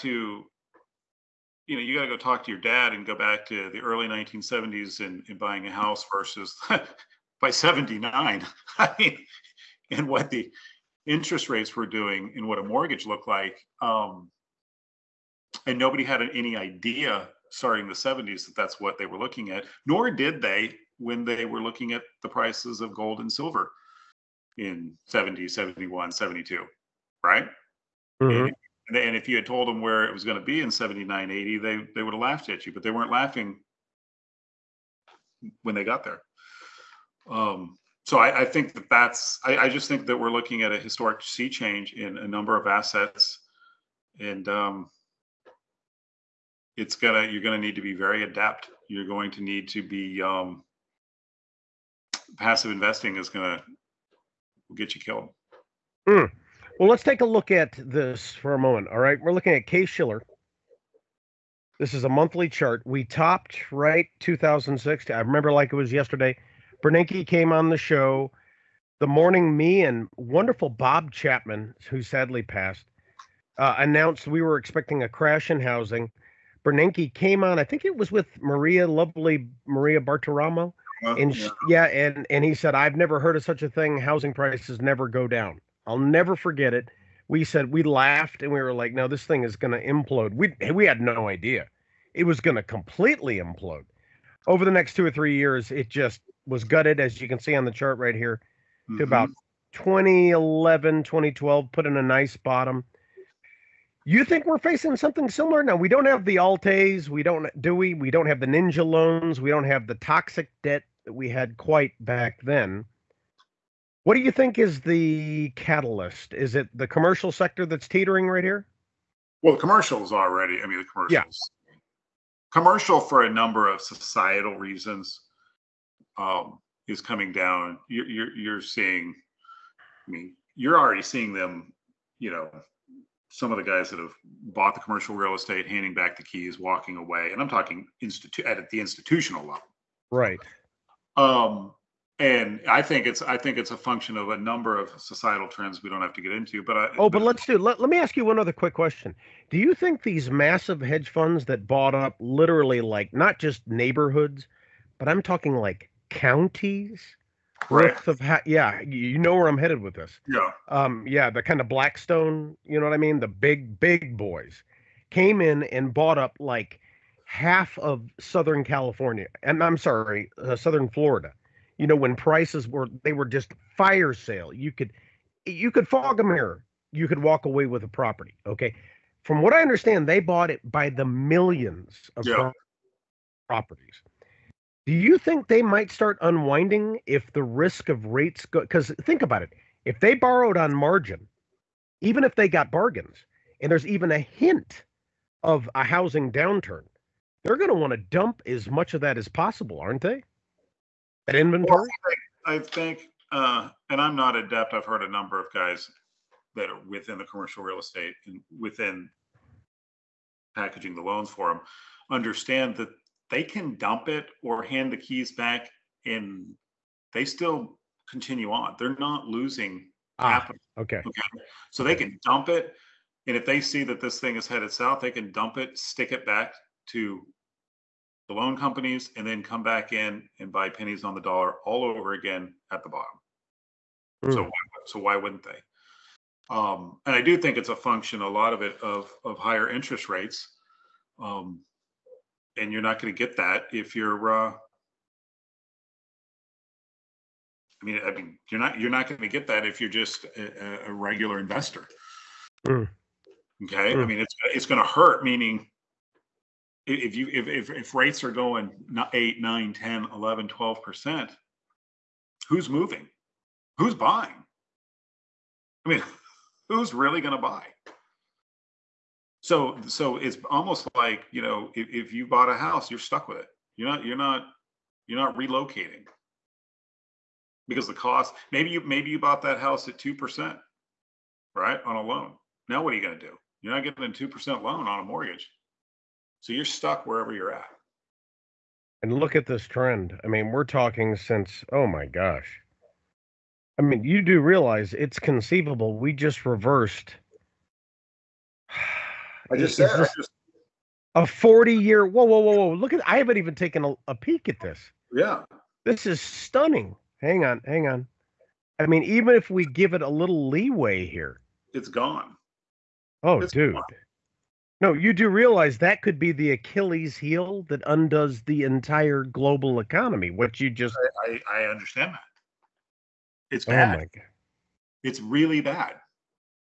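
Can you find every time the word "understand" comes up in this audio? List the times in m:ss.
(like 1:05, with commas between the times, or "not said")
2:59, 3:32, 5:21.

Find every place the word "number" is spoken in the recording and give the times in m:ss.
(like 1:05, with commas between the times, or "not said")
0:42, 2:03, 2:24, 3:25.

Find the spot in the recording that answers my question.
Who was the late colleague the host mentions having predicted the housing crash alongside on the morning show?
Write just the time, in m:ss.
1:10.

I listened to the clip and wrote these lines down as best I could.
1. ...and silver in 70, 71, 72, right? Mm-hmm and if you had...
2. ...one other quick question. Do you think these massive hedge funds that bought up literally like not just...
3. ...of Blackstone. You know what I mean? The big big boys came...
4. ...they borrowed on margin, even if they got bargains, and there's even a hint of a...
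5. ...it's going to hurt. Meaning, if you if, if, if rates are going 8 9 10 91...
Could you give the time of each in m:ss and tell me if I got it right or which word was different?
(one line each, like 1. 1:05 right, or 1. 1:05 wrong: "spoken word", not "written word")
1. 0:23 right
2. 2:28 right
3. 2:41 right
4. 3:09 right
5. 4:14 wrong: "11", not "91".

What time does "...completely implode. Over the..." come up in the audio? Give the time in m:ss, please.
1:32.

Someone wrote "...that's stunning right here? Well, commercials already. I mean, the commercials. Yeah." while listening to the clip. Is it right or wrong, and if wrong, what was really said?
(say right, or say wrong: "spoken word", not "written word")
wrong: "teetering", not "stunning".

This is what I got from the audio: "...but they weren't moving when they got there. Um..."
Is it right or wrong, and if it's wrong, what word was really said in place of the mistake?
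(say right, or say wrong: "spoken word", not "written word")
wrong: "laughing", not "moving".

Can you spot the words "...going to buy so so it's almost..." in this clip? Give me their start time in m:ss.
4:27.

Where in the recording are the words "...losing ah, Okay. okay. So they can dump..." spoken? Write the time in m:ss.
3:39.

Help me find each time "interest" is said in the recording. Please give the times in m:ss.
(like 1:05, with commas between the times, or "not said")
0:11, 3:59.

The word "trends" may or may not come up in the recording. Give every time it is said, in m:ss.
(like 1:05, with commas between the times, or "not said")
2:25, 4:49.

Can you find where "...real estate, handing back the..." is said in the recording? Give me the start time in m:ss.
2:15.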